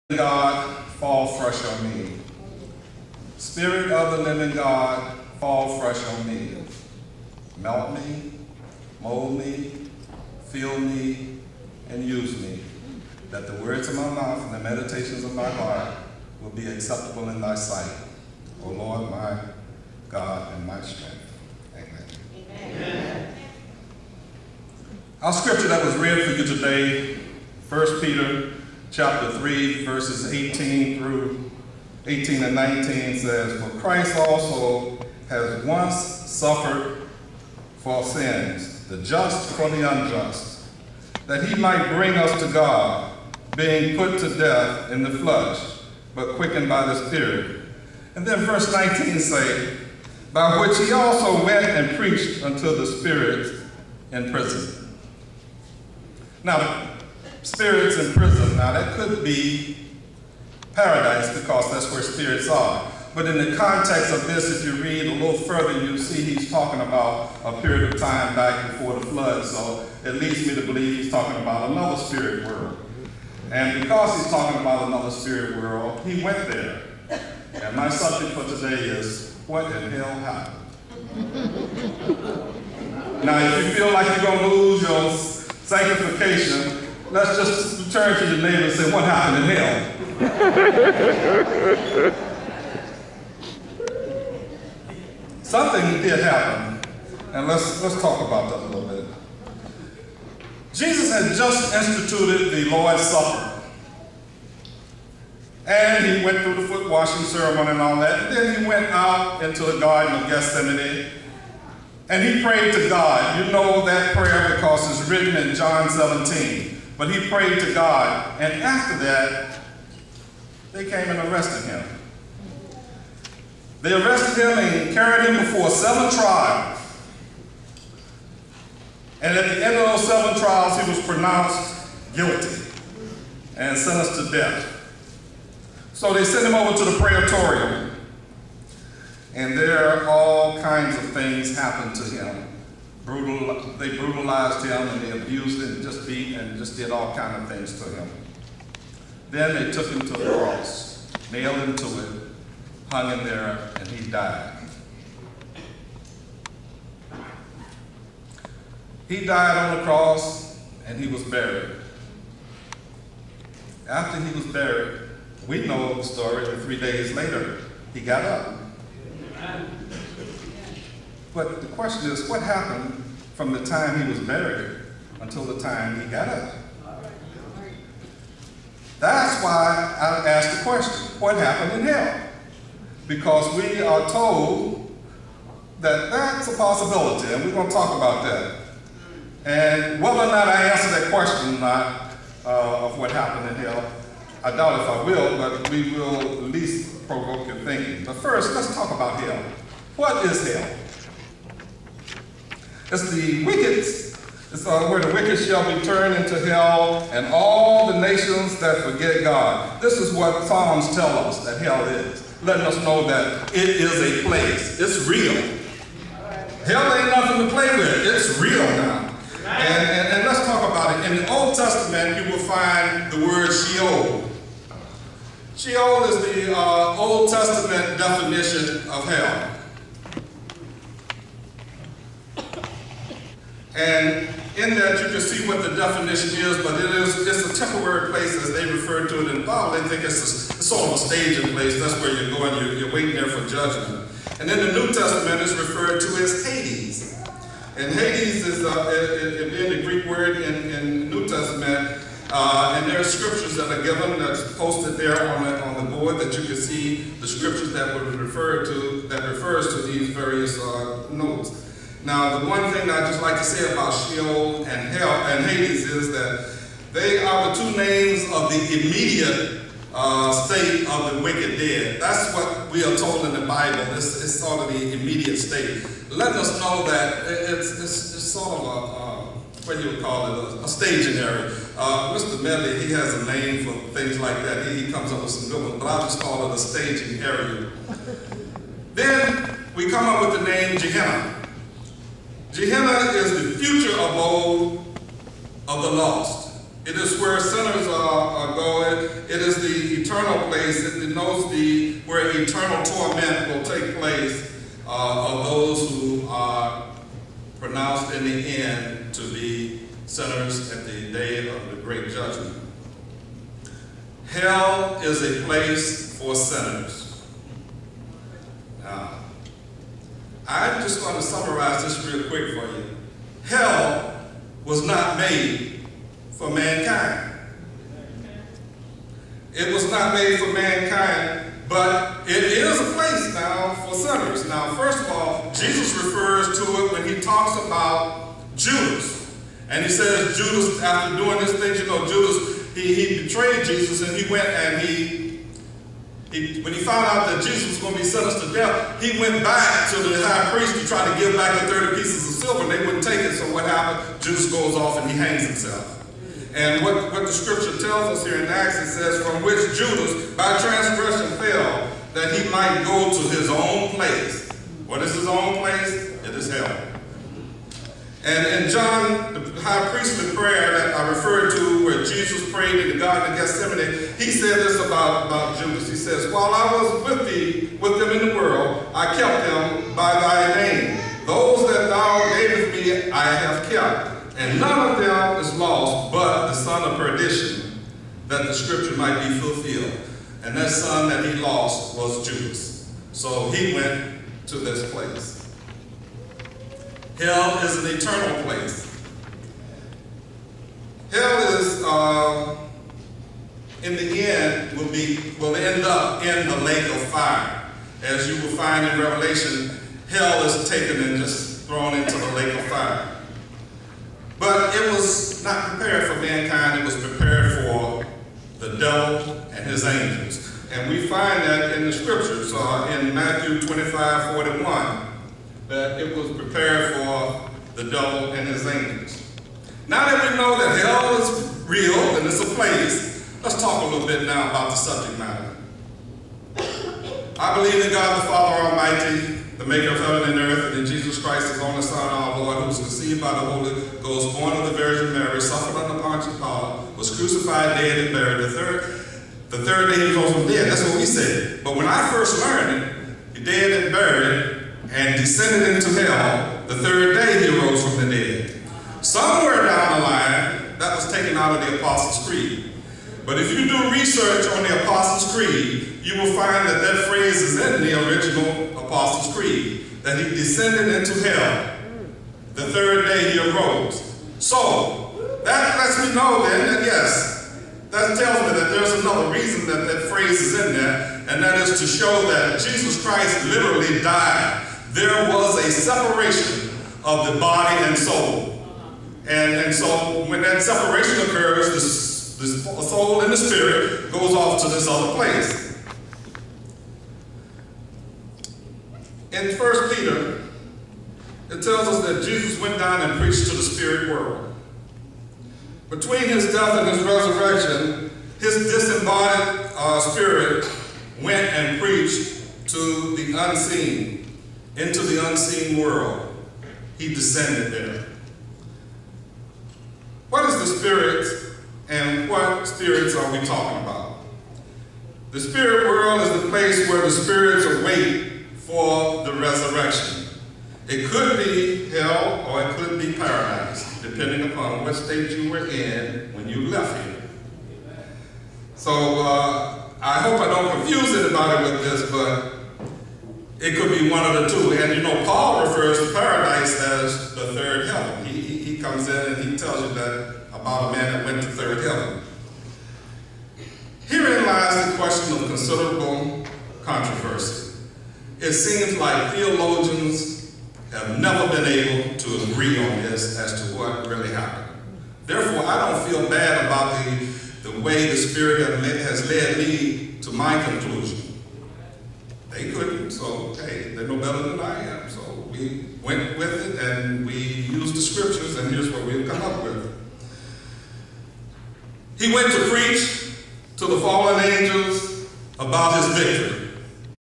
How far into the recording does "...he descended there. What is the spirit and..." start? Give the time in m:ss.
8:36.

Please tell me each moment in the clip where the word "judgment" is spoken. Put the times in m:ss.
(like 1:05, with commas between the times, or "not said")
4:03, 5:12.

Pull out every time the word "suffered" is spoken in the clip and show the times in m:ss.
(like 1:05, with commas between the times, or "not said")
0:35, 7:25.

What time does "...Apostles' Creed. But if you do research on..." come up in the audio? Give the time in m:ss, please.
7:41.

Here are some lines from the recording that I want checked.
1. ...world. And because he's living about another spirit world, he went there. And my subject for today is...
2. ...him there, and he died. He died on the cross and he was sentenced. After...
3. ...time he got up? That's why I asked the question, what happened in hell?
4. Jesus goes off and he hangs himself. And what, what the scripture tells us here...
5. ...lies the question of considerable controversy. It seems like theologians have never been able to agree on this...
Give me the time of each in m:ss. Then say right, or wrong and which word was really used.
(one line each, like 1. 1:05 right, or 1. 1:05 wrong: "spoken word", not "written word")
1. 1:12 wrong: "talking", not "living"
2. 2:33 wrong: "buried", not "sentenced"
3. 2:55 right
4. 5:54 right
5. 9:14 right.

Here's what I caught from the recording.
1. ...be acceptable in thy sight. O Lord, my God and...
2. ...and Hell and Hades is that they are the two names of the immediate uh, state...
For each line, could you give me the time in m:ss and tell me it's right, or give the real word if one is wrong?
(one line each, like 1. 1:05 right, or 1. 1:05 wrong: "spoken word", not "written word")
1. 0:16 right
2. 4:24 right.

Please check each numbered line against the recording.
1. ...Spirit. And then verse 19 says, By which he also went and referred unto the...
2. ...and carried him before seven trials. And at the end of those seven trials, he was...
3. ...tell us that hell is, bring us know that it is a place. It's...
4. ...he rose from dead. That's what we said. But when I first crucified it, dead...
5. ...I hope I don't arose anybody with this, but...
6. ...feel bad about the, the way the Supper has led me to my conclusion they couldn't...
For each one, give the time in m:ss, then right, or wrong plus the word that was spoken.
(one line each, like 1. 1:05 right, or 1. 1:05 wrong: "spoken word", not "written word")
1. 0:47 wrong: "preached", not "referred"
2. 2:04 right
3. 3:30 wrong: "letting", not "bring"
4. 7:30 wrong: "learned", not "crucified"
5. 9:00 wrong: "confuse", not "arose"
6. 9:26 wrong: "Spirit", not "Supper".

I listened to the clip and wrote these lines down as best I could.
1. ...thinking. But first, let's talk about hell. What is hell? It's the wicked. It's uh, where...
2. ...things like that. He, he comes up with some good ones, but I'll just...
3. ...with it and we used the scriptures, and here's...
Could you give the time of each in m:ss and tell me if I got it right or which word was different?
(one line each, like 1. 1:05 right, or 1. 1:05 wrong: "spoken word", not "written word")
1. 3:17 right
2. 4:43 right
3. 9:36 right.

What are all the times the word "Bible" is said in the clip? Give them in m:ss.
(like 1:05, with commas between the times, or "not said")
3:59, 4:33.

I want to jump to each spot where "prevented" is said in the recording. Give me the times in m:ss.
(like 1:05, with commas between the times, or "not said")
not said.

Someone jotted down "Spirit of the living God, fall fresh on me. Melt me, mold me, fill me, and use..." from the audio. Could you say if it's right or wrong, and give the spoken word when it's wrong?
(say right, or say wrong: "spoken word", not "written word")
right.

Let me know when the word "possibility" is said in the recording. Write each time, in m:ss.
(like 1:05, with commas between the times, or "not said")
3:06.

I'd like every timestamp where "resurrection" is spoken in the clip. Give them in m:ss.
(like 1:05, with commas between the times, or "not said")
8:27, 8:49.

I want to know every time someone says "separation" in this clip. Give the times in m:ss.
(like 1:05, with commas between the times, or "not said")
8:05, 8:10.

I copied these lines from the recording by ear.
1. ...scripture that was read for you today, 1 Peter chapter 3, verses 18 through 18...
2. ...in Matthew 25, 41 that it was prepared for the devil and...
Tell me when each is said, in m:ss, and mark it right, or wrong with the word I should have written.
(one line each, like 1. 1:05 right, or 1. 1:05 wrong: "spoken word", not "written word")
1. 0:25 right
2. 7:02 right.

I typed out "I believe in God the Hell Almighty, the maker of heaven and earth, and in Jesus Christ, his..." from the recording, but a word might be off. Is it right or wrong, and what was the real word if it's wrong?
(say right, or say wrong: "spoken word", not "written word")
wrong: "Father", not "Hell".